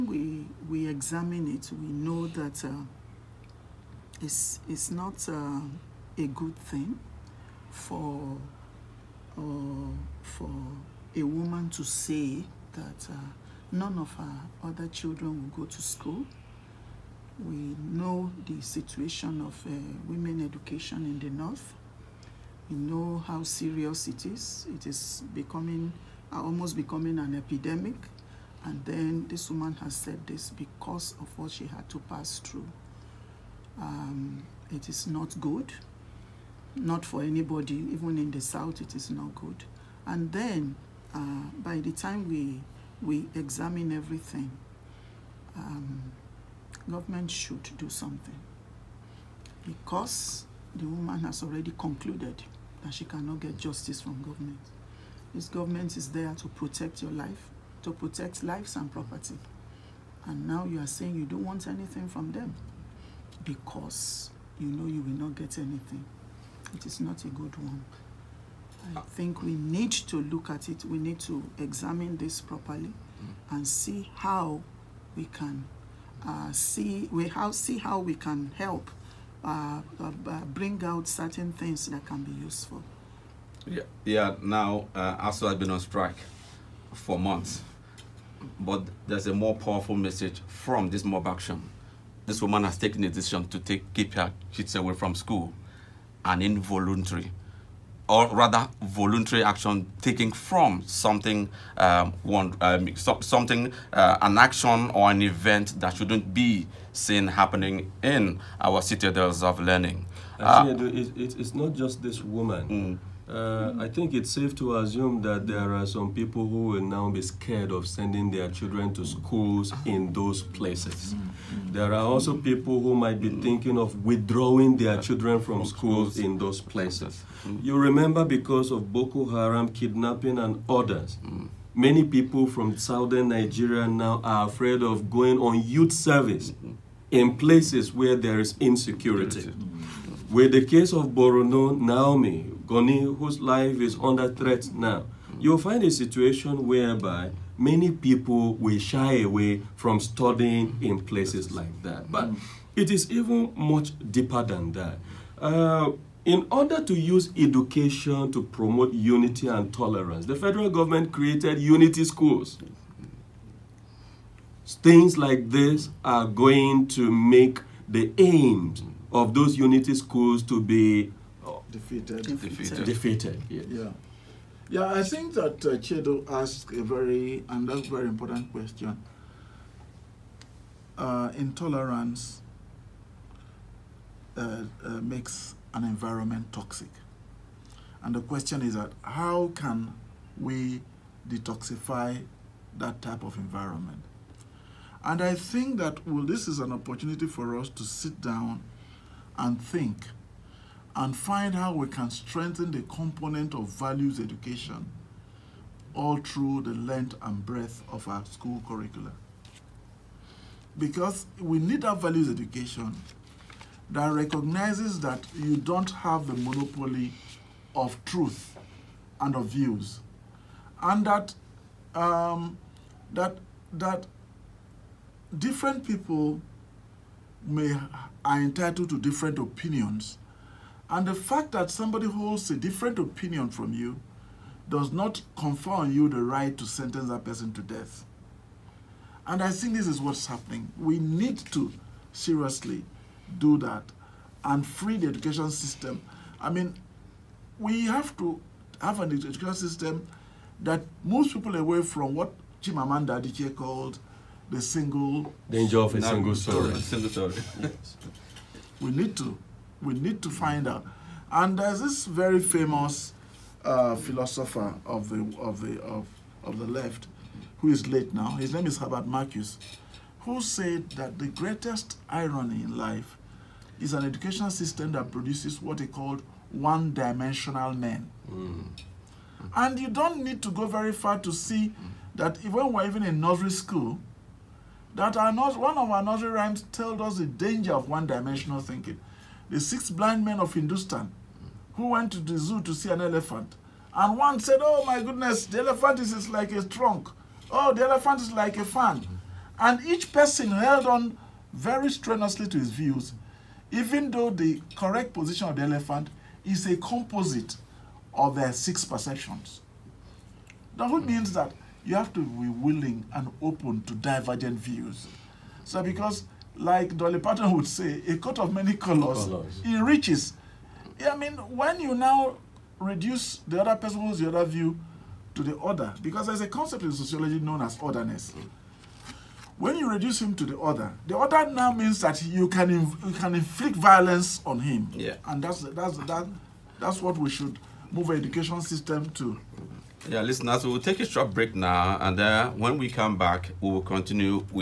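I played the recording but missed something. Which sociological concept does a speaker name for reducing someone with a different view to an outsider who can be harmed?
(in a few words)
Otherness.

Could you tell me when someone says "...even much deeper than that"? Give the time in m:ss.
2:33.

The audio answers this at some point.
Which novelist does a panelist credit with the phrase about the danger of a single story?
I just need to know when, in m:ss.
4:12.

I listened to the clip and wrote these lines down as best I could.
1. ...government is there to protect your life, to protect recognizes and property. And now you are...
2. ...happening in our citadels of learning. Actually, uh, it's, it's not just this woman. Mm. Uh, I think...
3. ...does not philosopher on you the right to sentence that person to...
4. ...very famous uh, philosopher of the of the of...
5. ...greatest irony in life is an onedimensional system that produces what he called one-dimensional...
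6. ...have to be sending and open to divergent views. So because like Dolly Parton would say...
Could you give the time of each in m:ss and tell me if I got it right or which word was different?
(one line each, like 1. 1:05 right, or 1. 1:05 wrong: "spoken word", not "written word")
1. 0:55 wrong: "lives", not "recognizes"
2. 1:47 right
3. 3:54 wrong: "confer", not "philosopher"
4. 4:22 right
5. 4:31 wrong: "educational", not "onedimensional"
6. 5:11 wrong: "willing", not "sending".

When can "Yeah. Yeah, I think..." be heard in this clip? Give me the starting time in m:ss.
2:53.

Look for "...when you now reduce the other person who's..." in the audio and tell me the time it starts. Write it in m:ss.
5:21.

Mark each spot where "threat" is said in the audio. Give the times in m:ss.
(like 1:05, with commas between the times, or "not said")
2:24.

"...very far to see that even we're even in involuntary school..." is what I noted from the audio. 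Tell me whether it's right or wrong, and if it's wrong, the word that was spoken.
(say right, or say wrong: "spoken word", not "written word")
wrong: "nursery", not "involuntary".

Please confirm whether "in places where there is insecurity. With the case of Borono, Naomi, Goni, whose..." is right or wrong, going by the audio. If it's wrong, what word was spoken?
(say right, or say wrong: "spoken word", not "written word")
right.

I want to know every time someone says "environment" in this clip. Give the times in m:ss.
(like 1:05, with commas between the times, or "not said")
3:05, 3:13.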